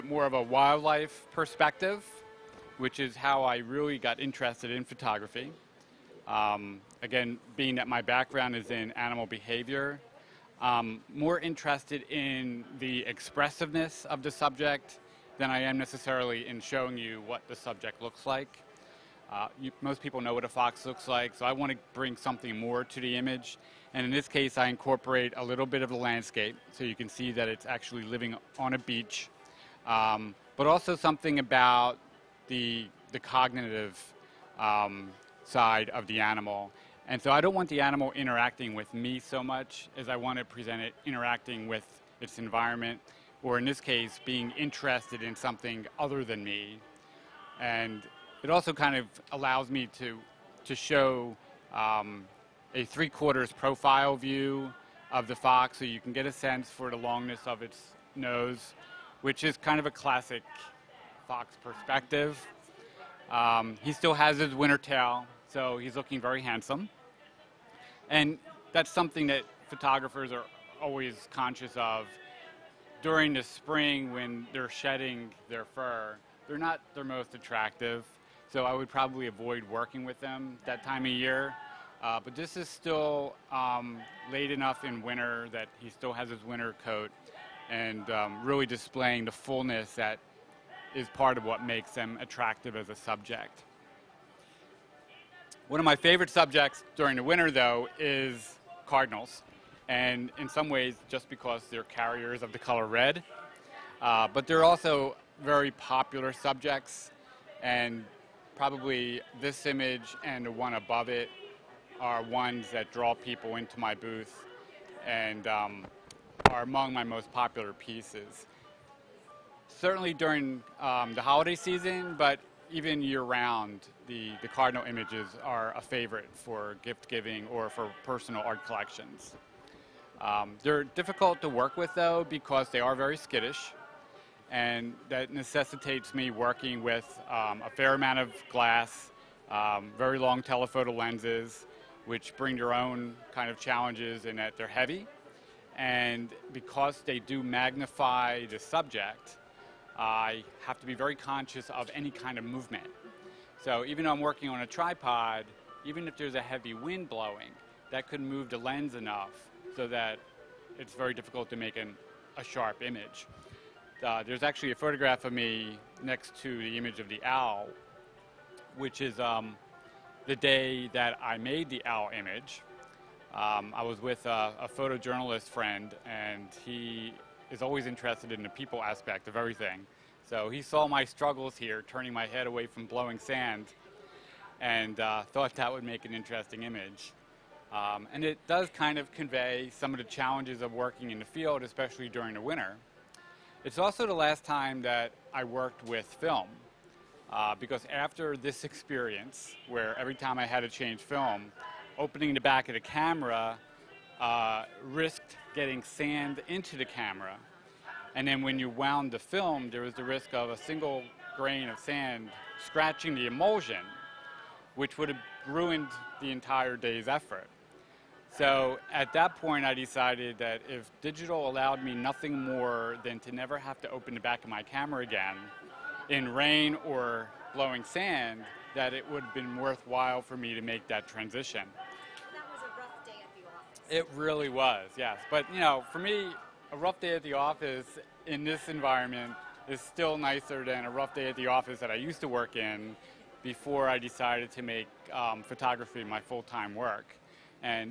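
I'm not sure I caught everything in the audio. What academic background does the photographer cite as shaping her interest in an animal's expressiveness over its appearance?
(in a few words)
Animal behavior.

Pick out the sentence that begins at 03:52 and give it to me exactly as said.
was a rough day at the office.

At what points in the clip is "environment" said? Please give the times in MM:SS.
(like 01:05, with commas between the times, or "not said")
00:42, 03:58.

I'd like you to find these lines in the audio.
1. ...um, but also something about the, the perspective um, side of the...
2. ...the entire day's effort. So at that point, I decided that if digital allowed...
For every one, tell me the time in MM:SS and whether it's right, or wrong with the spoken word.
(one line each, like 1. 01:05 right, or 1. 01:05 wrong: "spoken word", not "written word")
1. 00:29 wrong: "cognitive", not "perspective"
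2. 03:36 right.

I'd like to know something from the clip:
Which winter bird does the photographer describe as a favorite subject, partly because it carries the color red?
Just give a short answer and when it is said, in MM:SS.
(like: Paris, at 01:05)
Cardinals, at 01:38.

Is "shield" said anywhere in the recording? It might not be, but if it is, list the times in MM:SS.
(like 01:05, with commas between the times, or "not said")
not said.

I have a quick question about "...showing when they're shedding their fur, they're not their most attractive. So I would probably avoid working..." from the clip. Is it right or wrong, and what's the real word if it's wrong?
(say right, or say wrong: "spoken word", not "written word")
wrong: "spring", not "showing".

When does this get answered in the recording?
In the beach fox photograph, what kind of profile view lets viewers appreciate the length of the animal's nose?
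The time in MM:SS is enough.
00:52.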